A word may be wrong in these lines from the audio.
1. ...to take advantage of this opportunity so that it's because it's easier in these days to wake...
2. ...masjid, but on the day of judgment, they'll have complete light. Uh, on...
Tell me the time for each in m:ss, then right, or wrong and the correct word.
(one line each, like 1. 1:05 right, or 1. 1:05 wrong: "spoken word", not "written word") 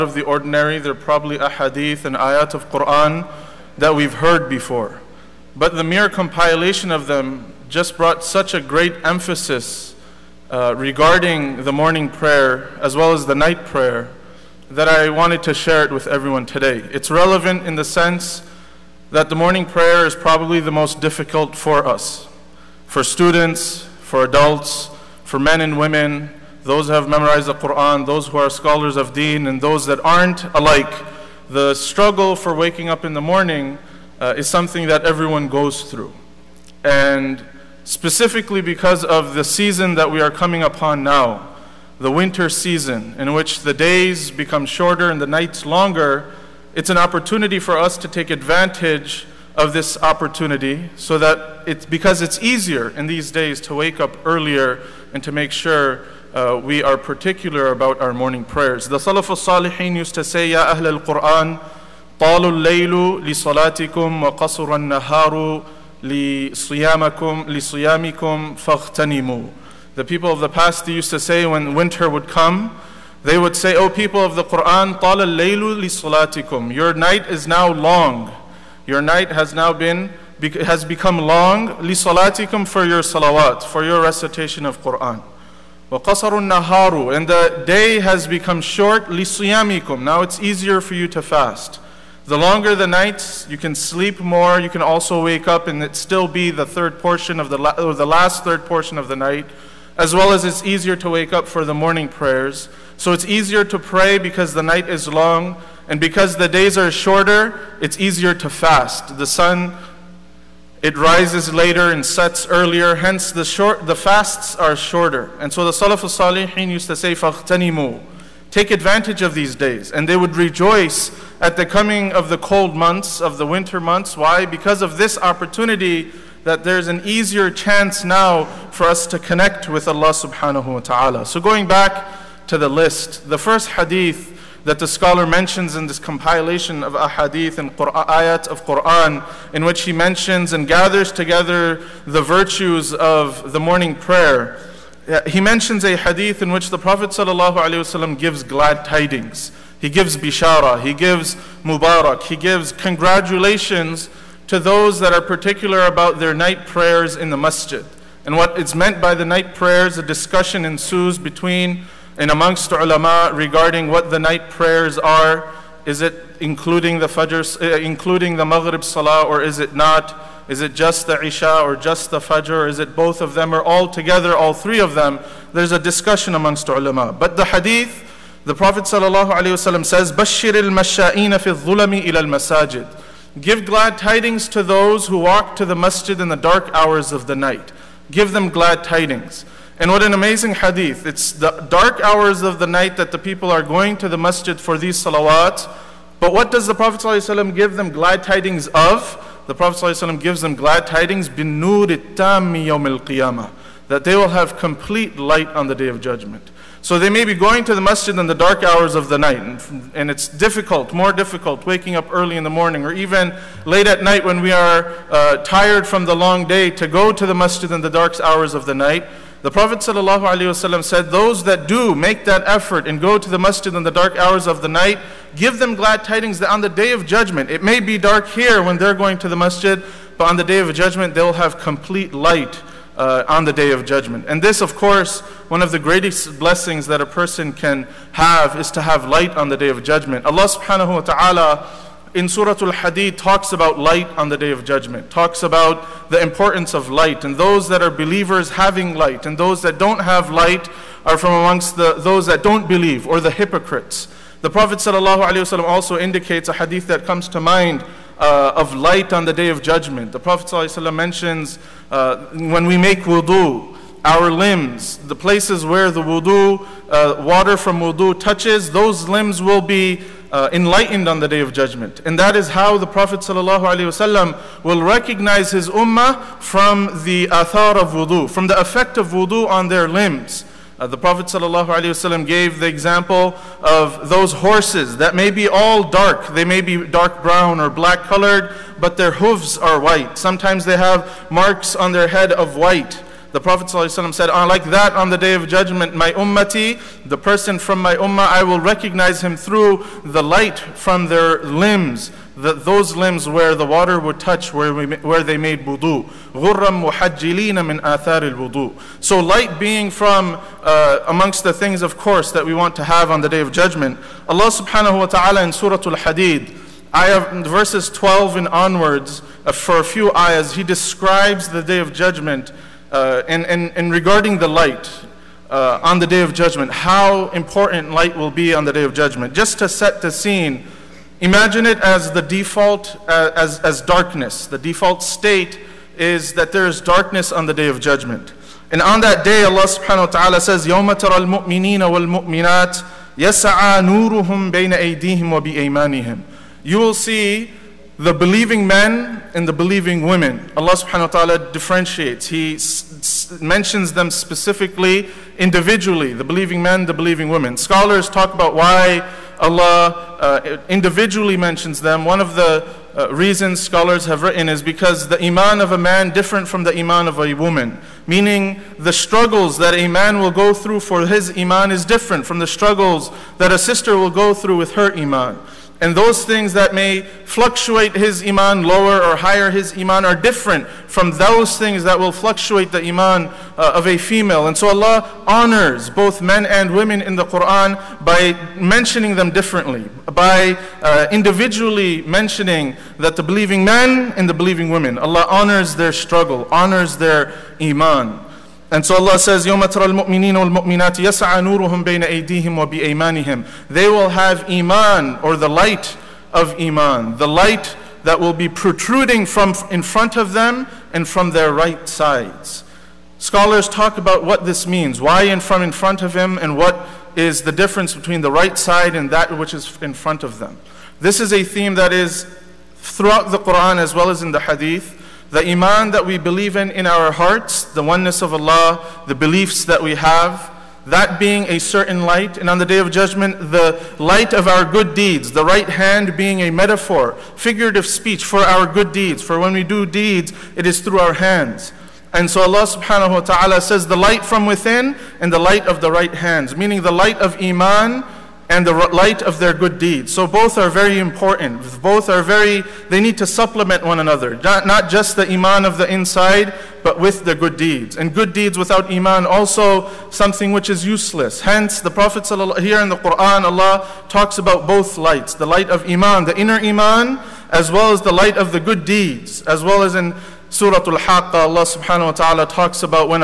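1. 0:47 right
2. 3:49 right.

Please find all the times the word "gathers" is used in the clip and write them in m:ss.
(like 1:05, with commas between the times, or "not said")
2:20.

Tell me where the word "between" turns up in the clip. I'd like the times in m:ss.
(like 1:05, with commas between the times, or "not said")
2:41, 6:57.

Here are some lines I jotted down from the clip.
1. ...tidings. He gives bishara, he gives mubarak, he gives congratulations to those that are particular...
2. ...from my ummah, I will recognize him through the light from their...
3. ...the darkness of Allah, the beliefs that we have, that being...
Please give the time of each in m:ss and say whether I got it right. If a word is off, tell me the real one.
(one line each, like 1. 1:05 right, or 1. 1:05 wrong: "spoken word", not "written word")
1. 2:28 right
2. 4:57 right
3. 7:07 wrong: "oneness", not "darkness".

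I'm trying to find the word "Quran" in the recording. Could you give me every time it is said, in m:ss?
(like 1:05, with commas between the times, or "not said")
0:02, 0:27, 1:14, 1:24, 2:18, 6:27, 7:03, 7:42.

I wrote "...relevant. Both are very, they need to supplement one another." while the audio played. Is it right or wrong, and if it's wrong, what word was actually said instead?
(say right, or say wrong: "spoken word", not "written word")
wrong: "important", not "relevant".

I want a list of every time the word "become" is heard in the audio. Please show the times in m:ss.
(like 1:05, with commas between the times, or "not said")
0:44, 1:20, 1:28.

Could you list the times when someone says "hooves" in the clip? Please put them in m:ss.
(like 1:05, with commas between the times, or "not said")
4:49.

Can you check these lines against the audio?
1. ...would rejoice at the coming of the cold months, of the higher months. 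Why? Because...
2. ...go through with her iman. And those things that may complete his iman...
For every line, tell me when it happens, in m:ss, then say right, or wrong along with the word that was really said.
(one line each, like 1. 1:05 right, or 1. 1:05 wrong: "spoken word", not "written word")
1. 2:00 wrong: "winter", not "higher"
2. 6:14 wrong: "fluctuate", not "complete".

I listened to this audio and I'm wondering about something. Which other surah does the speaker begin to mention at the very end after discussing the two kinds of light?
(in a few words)
Surah Al-Haqqa.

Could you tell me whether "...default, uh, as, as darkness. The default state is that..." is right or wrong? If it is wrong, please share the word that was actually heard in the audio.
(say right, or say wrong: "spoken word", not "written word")
right.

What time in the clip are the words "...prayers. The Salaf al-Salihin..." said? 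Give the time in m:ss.
0:58.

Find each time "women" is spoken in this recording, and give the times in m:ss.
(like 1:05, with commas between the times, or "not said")
0:25, 5:50, 5:57, 6:26, 6:34.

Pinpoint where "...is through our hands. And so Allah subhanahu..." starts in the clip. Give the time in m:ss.
7:20.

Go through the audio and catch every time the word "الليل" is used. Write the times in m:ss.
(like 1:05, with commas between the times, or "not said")
1:02, 1:15.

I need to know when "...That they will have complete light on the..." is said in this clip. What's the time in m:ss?
3:21.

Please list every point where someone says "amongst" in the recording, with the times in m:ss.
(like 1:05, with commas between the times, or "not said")
2:42, 2:56, 4:11, 5:11.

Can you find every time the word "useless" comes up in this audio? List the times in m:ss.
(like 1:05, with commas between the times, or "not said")
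7:40.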